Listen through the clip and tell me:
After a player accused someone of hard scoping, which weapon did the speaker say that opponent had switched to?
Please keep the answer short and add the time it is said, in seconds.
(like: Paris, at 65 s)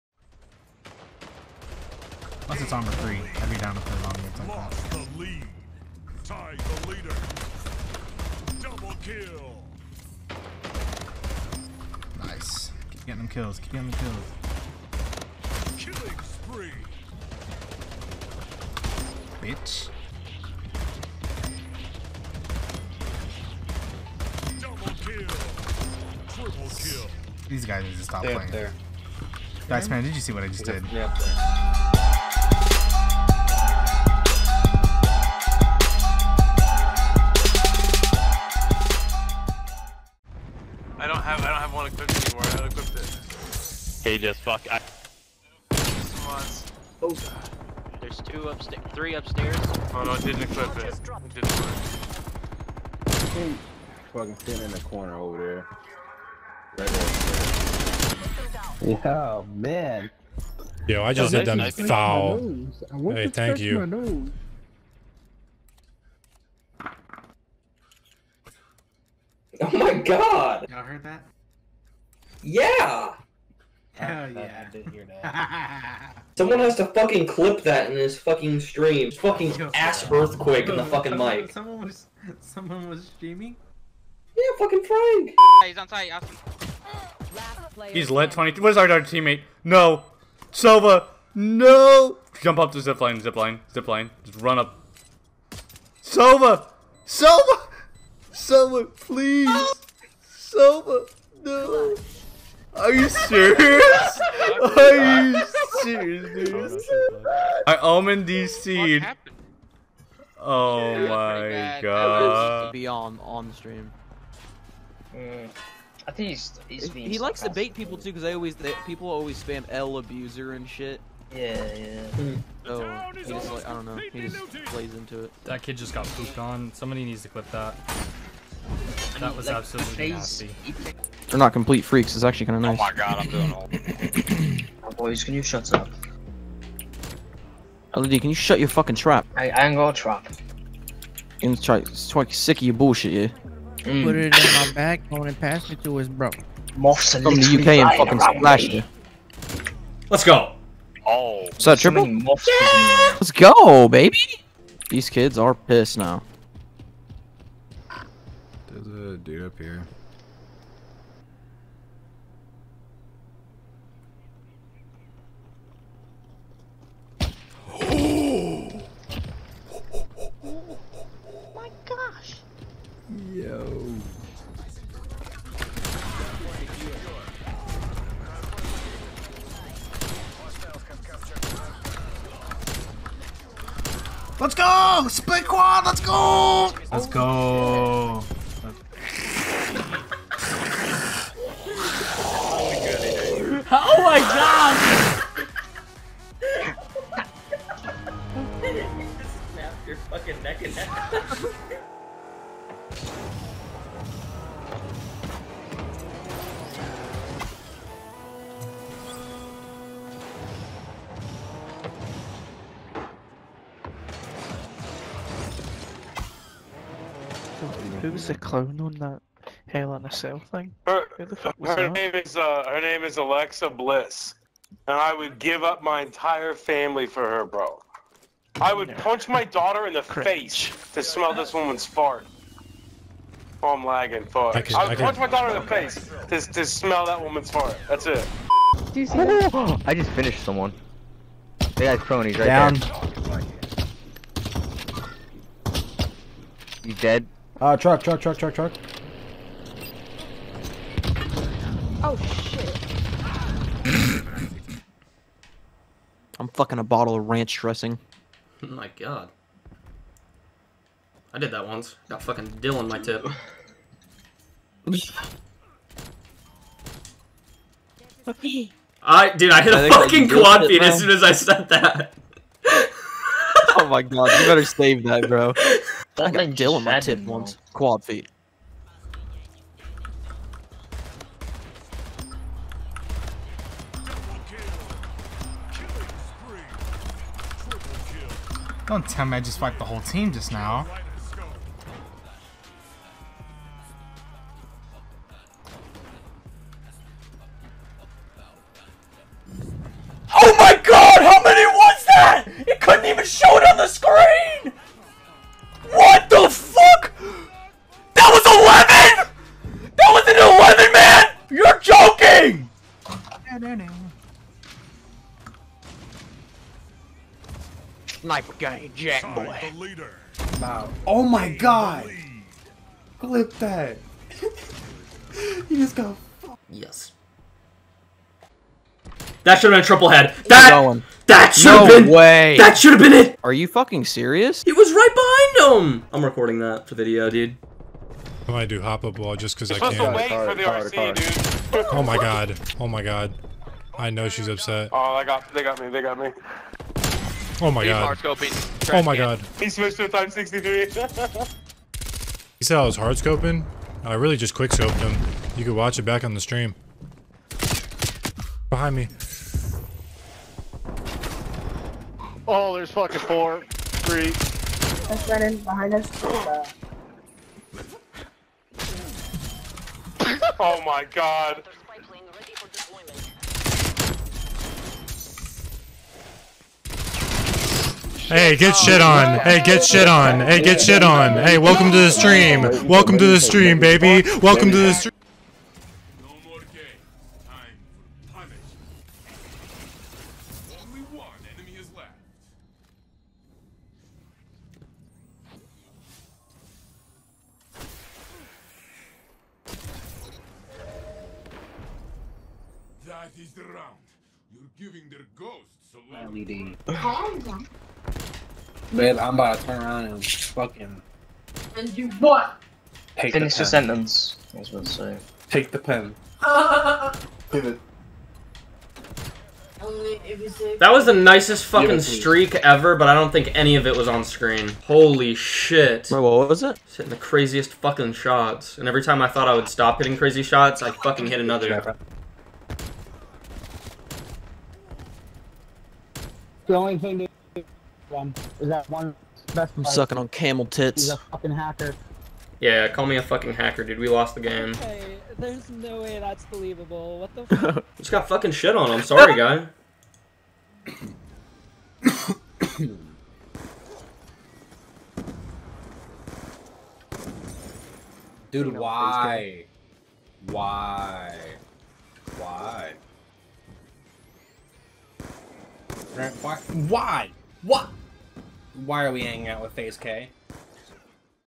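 Type 63, at 350 s.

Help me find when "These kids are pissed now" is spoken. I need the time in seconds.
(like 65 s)
154 s.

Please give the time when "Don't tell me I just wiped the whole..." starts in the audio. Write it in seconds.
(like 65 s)
288 s.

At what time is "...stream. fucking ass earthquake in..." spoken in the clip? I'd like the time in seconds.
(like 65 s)
78 s.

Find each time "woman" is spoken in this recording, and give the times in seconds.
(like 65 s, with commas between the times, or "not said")
231 s, 237 s.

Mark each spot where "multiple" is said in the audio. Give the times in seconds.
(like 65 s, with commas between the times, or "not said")
not said.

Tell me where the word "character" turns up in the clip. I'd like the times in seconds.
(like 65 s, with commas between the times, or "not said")
not said.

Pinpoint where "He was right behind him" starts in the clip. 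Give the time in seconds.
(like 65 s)
334 s.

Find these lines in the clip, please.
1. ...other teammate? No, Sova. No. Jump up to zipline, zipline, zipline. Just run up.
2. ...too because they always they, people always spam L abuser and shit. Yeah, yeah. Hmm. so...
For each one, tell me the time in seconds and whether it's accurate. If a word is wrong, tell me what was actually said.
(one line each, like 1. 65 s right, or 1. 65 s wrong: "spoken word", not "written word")
1. 88 s right
2. 117 s right.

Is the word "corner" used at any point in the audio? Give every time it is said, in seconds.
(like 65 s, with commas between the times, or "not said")
54 s.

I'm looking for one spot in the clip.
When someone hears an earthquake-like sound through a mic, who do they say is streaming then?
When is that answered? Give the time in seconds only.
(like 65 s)
84 s.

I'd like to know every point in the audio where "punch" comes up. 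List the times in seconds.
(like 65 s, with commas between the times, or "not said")
228 s, 235 s.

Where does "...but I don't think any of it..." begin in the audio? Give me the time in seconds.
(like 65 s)
422 s.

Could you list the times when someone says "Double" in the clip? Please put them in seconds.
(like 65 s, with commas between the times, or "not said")
8 s, 24 s.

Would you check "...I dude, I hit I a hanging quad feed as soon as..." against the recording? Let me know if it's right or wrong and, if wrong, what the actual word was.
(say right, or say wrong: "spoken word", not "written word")
wrong: "fucking", not "hanging".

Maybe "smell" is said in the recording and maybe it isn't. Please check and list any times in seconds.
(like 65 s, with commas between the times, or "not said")
231 s, 236 s.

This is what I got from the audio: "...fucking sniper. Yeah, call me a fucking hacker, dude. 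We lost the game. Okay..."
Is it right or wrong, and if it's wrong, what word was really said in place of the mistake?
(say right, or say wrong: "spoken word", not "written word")
wrong: "hacker", not "sniper".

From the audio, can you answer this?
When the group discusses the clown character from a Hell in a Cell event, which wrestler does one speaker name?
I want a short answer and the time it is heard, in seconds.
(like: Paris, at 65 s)
Alexa Bliss, at 223 s.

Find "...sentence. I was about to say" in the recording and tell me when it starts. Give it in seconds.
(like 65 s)
413 s.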